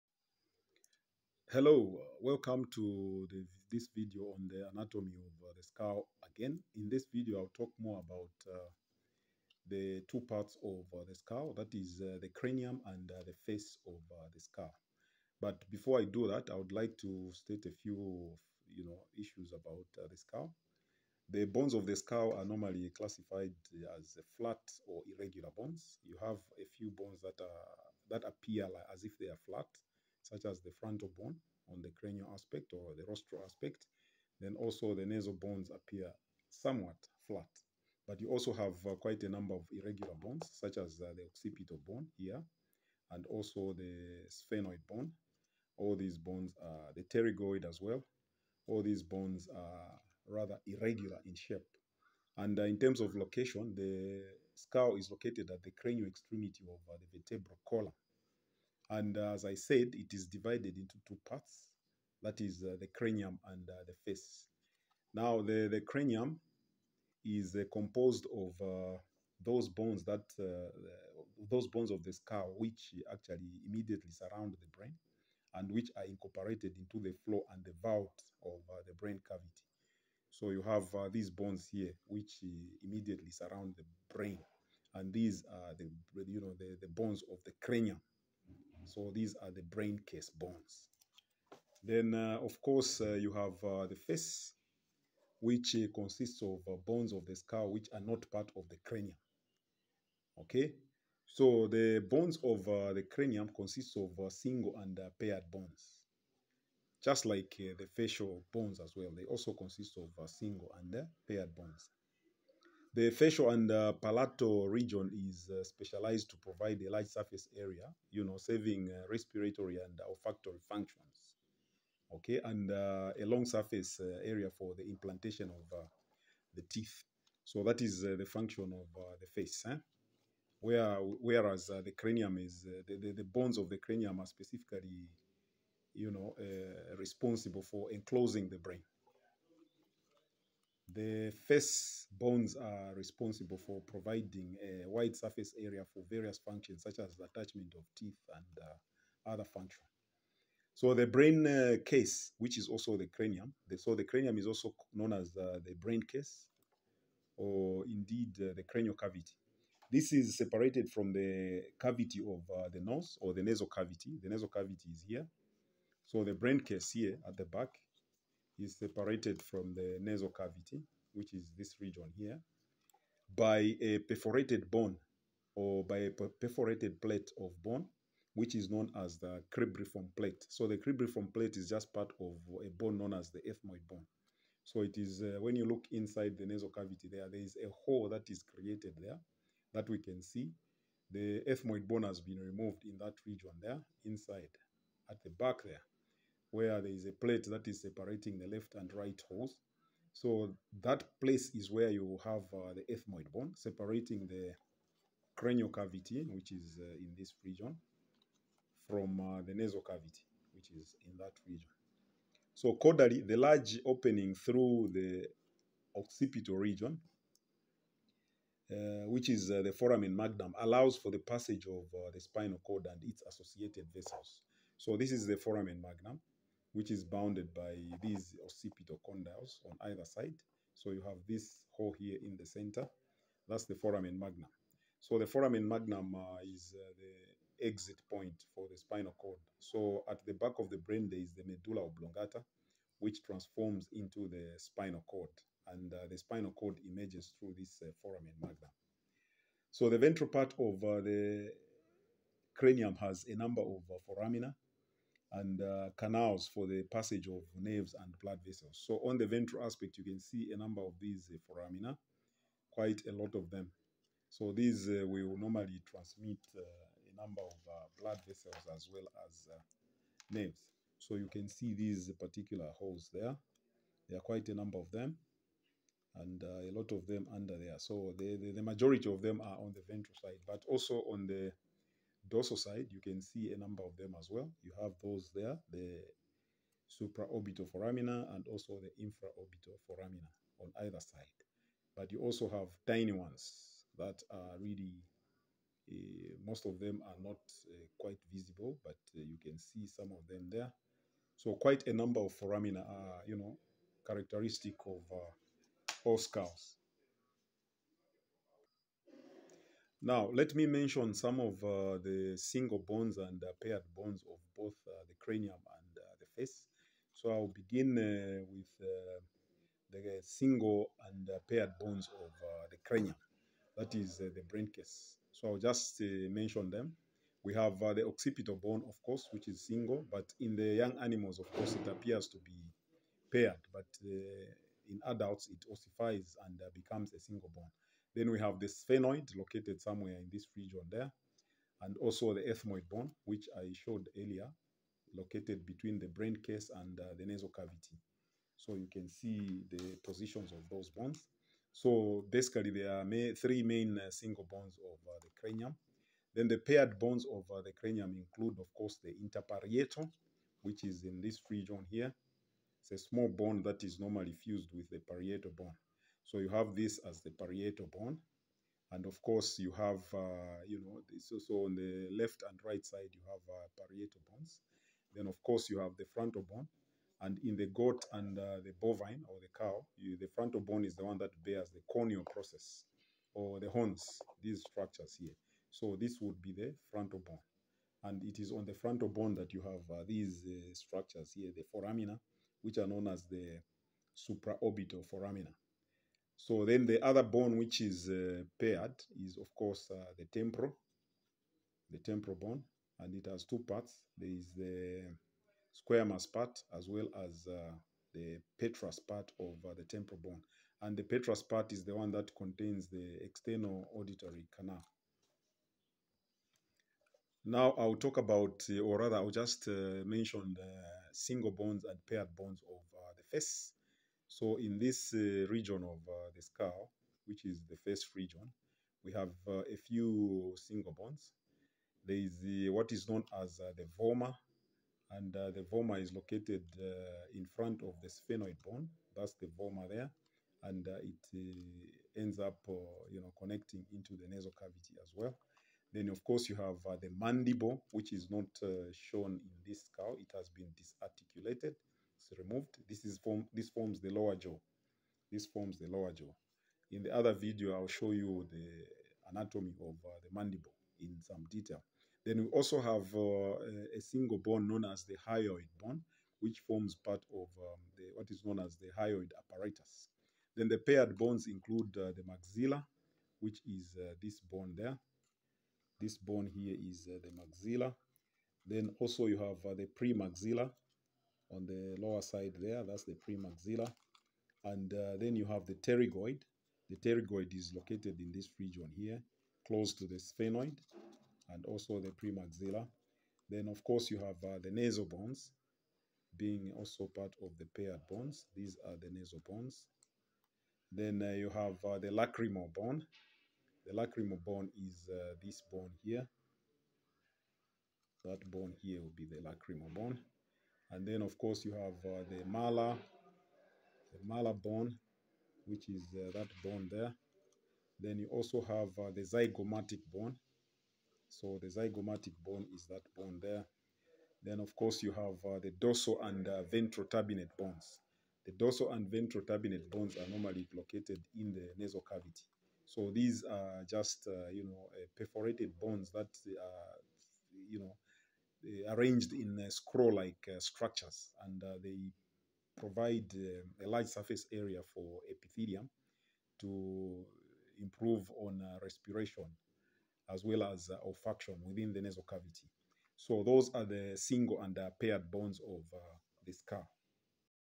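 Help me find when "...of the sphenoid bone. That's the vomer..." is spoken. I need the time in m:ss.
7:17.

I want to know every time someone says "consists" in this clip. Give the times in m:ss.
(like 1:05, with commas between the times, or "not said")
1:35, 1:43, 1:49.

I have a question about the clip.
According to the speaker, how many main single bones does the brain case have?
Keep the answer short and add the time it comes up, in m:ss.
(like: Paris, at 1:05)
3, at 5:53.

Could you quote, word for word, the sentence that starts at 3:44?
So this is the foramen magnum which is bounded by these occipital condyles on either side.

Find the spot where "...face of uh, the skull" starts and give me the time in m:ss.
0:13.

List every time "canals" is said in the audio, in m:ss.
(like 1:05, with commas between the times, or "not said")
4:15, 6:54.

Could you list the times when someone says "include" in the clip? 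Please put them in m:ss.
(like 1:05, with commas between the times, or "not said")
5:58, 7:51.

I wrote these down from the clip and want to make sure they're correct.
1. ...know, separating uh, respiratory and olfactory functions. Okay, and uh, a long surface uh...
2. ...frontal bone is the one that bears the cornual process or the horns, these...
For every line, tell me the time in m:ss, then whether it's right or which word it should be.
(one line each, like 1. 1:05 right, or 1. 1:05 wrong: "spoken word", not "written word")
1. 1:58 wrong: "saving", not "separating"
2. 6:20 right.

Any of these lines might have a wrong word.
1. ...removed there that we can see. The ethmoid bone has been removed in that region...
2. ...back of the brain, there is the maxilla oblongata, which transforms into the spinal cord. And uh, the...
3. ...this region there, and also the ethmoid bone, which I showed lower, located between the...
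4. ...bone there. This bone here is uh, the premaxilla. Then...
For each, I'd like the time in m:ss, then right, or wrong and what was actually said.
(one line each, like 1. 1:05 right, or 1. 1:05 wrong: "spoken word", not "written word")
1. 3:08 wrong: "created", not "removed"
2. 4:00 wrong: "medulla", not "maxilla"
3. 5:40 wrong: "earlier", not "lower"
4. 7:54 wrong: "maxilla", not "premaxilla".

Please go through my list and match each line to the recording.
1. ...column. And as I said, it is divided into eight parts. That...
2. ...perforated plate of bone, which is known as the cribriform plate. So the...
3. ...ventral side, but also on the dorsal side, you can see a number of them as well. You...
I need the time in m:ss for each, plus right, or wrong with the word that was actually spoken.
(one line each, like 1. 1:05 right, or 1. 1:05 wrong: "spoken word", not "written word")
1. 0:57 wrong: "two", not "eight"
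2. 2:56 right
3. 4:39 right.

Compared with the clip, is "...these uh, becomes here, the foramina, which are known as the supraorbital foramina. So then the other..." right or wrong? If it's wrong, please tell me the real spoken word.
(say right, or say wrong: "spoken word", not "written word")
wrong: "structures", not "becomes".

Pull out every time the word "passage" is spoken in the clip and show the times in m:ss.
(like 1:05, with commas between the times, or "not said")
3:41, 4:16.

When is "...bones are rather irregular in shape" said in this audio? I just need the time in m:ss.
0:49.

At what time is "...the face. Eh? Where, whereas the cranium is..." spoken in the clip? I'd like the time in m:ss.
2:09.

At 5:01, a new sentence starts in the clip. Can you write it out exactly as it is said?
So quite a number of foramina are, you know, characteristic of uh, all skulls.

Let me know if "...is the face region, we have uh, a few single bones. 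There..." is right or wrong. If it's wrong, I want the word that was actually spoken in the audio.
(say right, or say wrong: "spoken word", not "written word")
right.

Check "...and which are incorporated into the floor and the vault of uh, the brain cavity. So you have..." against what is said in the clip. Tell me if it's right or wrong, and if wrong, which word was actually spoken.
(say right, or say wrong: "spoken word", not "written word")
right.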